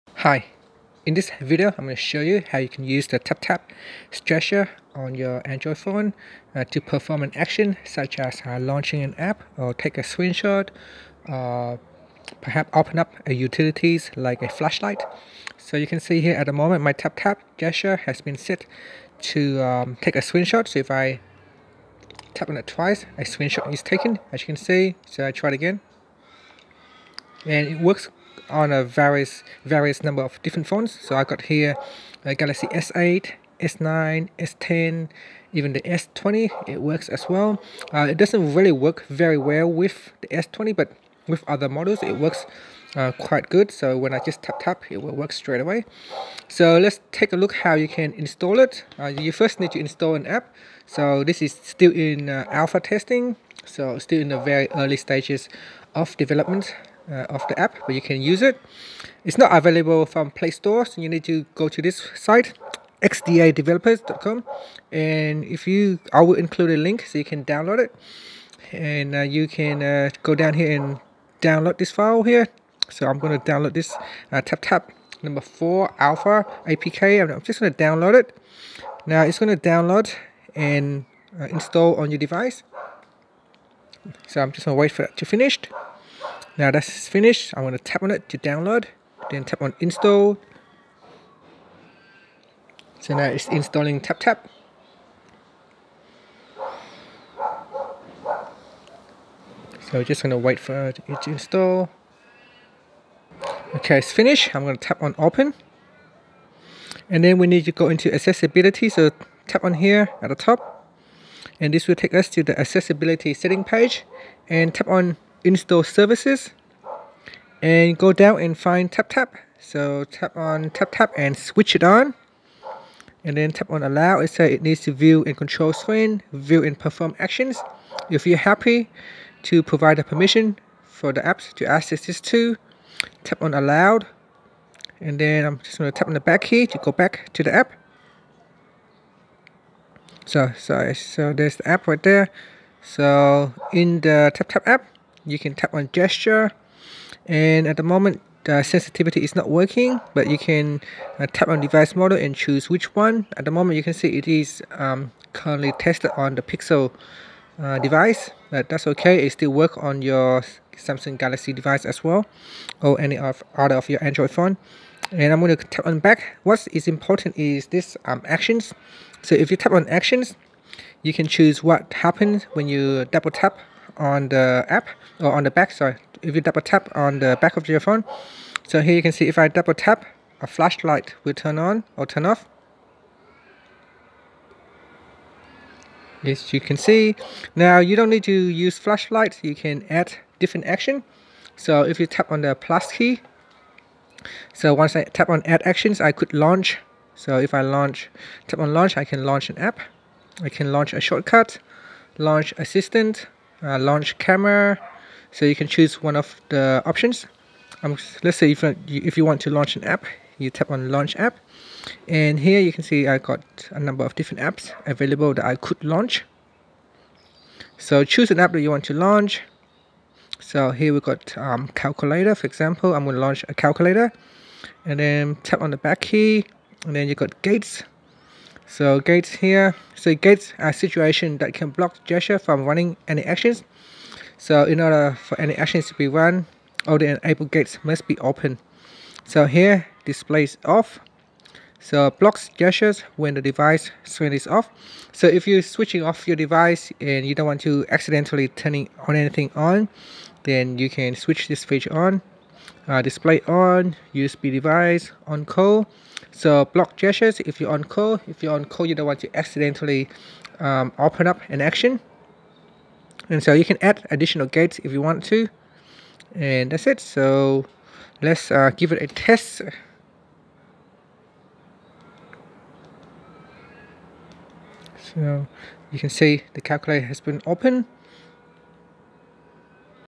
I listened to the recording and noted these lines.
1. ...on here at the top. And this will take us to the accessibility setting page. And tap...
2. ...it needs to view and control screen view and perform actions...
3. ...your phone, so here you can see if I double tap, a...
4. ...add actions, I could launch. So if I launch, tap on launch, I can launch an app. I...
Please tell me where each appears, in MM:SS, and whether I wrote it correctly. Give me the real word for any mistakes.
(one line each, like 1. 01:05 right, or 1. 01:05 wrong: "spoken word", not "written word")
1. 01:49 right
2. 02:04 right
3. 02:57 right
4. 03:15 right.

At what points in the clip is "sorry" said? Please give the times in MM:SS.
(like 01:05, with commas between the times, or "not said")
02:20, 02:55.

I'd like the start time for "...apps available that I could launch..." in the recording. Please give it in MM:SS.
03:34.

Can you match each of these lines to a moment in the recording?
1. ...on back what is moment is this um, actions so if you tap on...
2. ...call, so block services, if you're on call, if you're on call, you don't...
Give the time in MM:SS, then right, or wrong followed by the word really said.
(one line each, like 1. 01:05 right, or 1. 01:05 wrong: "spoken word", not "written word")
1. 02:45 wrong: "important", not "moment"
2. 04:15 wrong: "gestures", not "services".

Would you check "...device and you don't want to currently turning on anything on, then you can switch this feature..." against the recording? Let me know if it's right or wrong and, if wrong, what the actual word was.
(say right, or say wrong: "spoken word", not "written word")
wrong: "accidentally", not "currently".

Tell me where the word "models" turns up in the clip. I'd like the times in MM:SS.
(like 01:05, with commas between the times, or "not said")
00:41, 02:31.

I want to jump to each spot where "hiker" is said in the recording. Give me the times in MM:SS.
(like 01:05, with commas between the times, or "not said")
not said.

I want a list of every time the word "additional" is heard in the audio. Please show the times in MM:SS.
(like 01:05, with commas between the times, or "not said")
04:24.